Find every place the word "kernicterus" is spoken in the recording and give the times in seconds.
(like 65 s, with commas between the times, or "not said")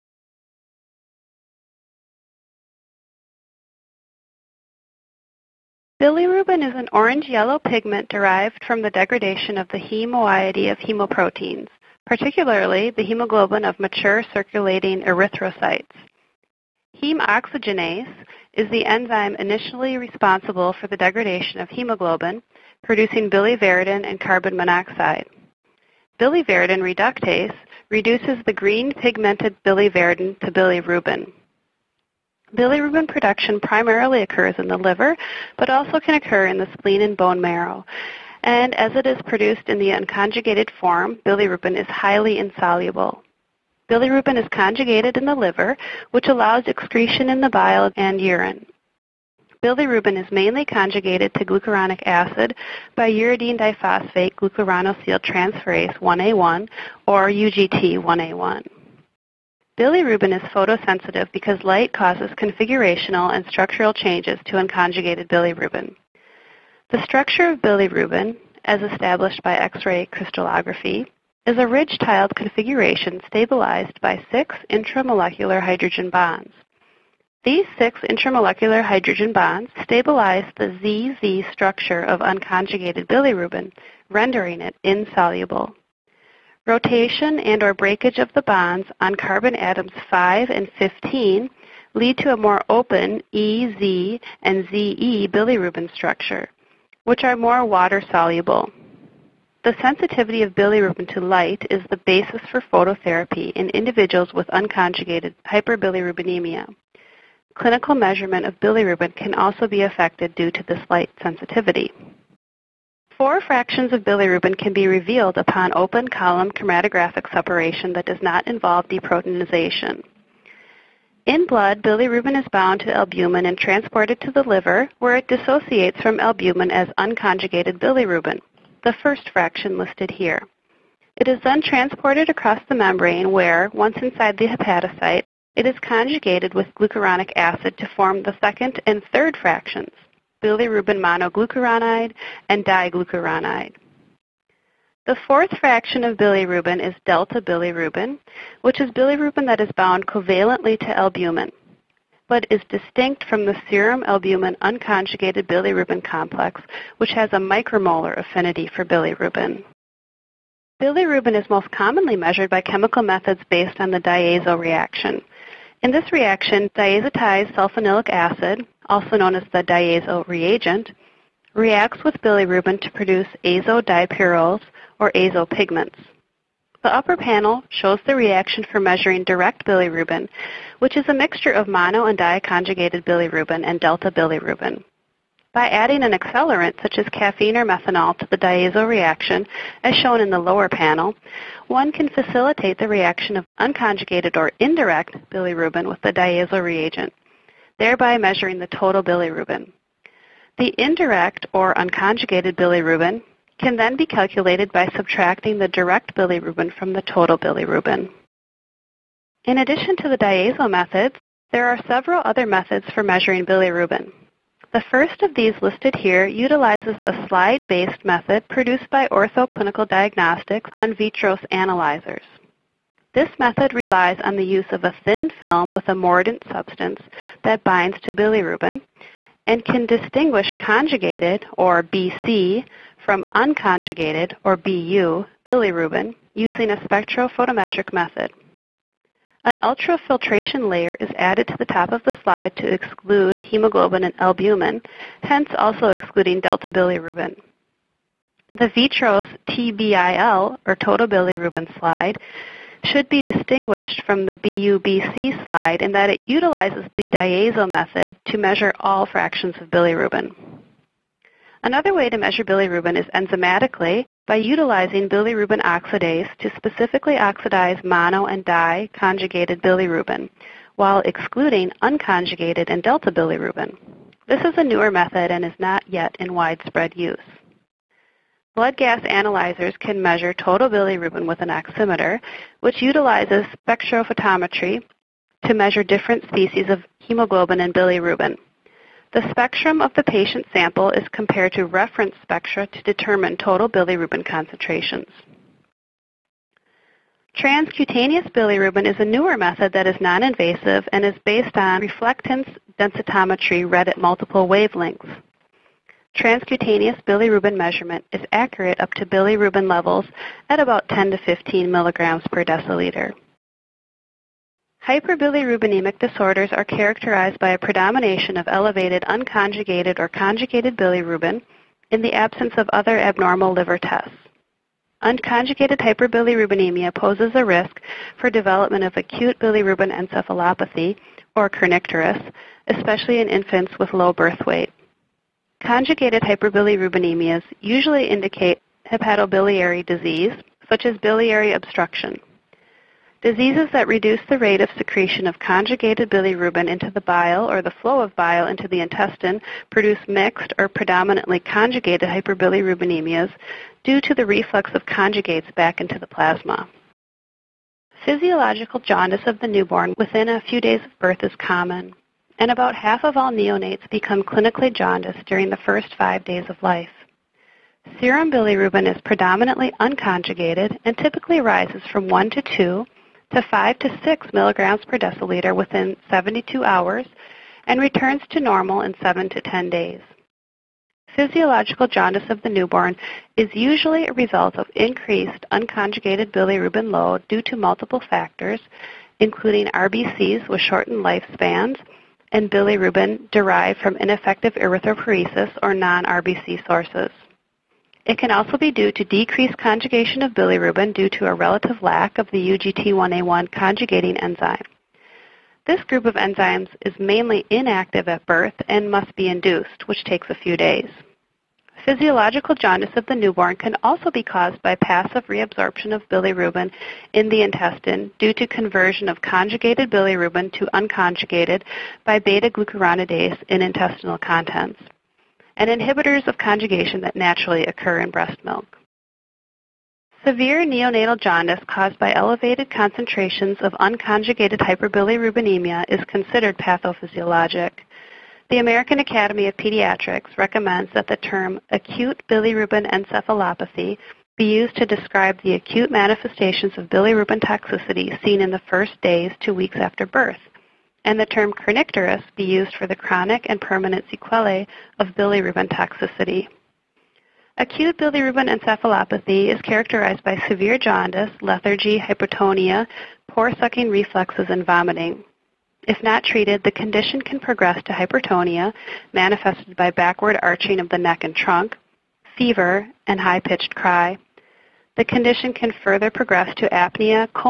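331 s, 451 s.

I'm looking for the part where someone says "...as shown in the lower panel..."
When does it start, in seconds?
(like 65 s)
189 s.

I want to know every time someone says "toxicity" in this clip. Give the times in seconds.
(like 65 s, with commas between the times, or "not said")
447 s, 455 s.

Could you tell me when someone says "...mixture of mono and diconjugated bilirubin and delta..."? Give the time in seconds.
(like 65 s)
181 s.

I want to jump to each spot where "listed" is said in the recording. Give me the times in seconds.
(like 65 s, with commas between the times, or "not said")
129 s, 215 s.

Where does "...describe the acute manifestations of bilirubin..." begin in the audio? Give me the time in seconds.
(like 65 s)
444 s.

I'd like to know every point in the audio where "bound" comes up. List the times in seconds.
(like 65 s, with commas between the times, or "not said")
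122 s, 149 s.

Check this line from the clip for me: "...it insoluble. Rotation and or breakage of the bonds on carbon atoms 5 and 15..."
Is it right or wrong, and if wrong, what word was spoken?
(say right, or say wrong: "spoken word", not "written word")
right.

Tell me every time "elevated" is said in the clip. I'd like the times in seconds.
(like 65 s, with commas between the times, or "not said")
318 s, 432 s.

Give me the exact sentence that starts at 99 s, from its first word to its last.
The sensitivity of bilirubin to light is the basis for phototherapy in individuals with unconjugated hyperbilirubinemia.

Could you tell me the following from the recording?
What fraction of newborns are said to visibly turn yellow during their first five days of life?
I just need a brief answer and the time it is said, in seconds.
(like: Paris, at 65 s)
about half, at 362 s.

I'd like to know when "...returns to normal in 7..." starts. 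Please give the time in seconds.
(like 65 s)
377 s.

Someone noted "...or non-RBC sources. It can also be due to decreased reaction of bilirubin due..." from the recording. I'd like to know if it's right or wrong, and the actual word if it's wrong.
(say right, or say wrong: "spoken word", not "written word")
wrong: "conjugation", not "reaction".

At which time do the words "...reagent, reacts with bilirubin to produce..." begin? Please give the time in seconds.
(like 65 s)
170 s.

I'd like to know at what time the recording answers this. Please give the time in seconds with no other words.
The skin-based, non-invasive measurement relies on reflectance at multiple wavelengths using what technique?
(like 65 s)
301 s.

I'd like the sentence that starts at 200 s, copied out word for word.
The indirect or unconjugated bilirubin can then be calculated by subtracting the direct bilirubin from the total bilirubin.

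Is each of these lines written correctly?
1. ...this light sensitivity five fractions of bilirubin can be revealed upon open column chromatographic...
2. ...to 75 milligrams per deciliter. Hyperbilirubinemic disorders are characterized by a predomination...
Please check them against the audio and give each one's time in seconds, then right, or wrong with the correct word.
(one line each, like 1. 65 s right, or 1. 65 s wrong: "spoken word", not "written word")
1. 110 s wrong: "four", not "five"
2. 311 s wrong: "15", not "75".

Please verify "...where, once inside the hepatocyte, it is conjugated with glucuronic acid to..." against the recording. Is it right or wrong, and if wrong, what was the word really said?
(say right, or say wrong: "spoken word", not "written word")
right.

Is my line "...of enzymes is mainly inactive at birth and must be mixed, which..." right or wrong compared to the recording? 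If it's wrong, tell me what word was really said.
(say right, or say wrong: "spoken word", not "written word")
wrong: "induced", not "mixed".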